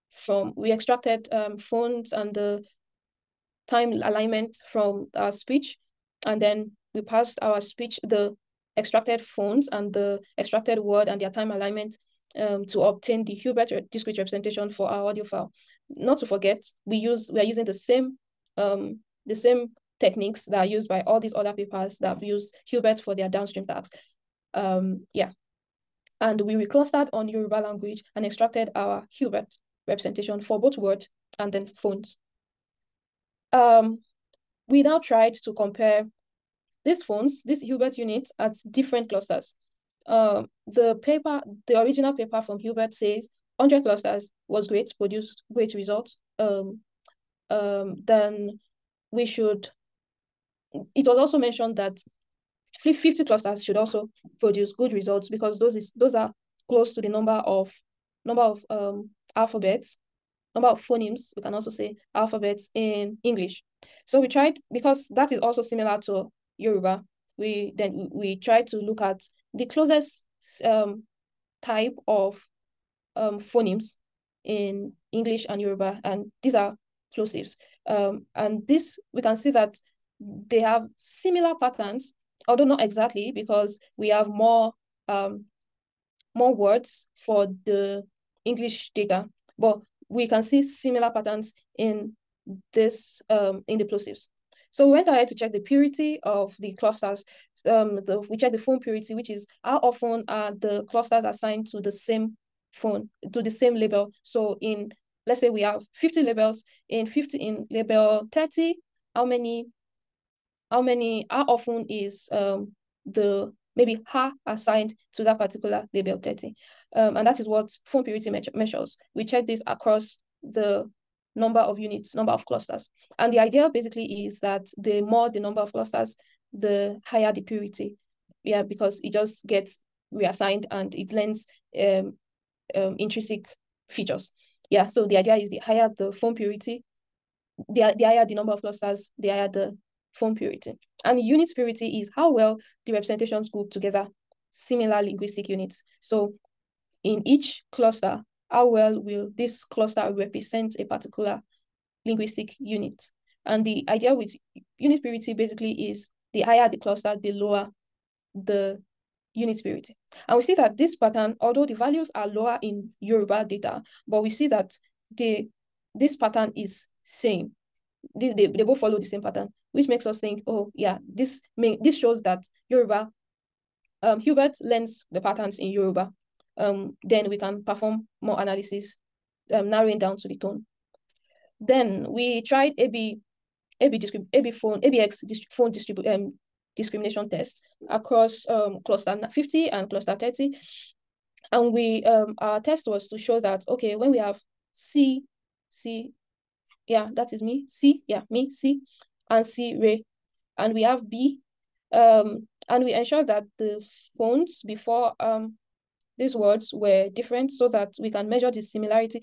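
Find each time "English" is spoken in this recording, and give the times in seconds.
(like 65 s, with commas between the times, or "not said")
63 s, 75 s, 88 s.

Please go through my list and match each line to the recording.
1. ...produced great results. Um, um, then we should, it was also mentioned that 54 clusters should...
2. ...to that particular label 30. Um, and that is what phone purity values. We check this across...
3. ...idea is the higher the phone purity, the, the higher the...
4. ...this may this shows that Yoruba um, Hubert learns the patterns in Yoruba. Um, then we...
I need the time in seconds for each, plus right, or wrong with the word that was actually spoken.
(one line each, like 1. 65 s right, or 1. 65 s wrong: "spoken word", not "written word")
1. 44 s wrong: "50", not "54"
2. 115 s wrong: "measures", not "values"
3. 135 s right
4. 171 s right.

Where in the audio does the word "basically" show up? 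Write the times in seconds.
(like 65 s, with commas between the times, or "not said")
123 s, 155 s.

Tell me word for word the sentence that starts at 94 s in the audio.
So we went ahead to check the purity of the clusters.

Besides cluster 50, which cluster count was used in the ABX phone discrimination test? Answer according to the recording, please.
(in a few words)
30.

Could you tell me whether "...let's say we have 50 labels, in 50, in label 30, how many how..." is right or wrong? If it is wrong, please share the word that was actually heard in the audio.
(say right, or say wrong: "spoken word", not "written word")
right.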